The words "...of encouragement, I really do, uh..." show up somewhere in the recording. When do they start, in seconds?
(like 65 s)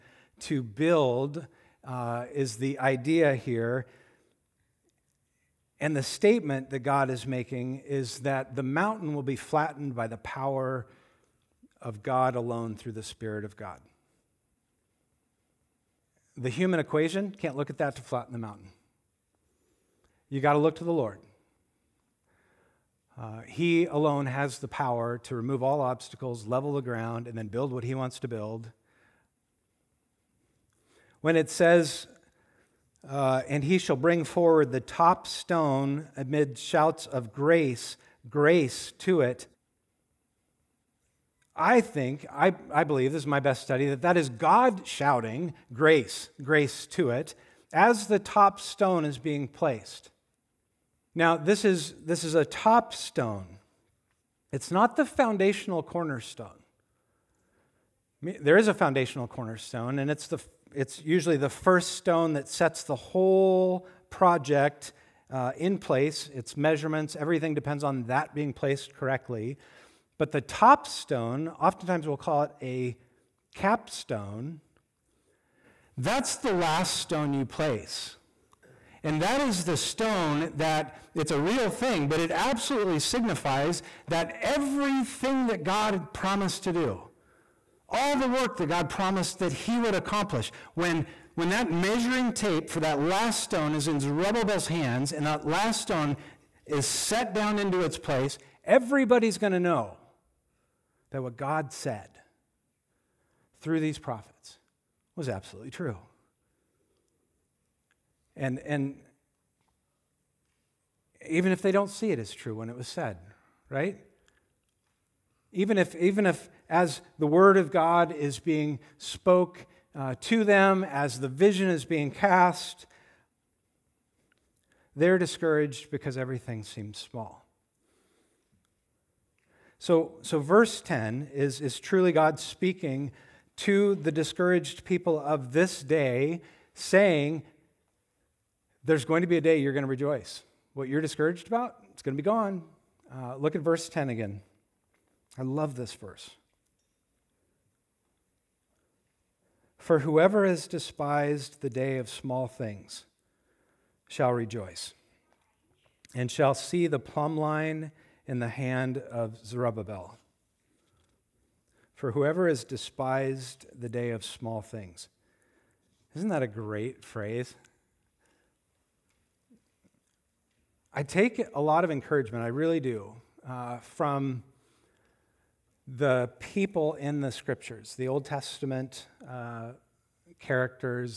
171 s.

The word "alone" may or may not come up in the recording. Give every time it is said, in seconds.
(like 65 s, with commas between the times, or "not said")
12 s, 23 s.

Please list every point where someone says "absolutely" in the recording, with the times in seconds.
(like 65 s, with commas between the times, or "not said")
82 s, 105 s.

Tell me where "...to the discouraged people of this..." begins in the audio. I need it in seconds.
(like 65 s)
133 s.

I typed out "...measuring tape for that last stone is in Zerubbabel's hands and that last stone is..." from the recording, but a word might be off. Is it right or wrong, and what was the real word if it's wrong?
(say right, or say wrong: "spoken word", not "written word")
right.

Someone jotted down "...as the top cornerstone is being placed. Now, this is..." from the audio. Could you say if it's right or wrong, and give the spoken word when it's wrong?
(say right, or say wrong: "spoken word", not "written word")
wrong: "stone", not "cornerstone".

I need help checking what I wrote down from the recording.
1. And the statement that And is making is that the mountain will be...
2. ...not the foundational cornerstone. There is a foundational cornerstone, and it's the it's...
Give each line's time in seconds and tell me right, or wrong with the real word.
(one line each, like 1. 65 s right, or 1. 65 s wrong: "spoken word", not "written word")
1. 5 s wrong: "God", not "And"
2. 54 s right.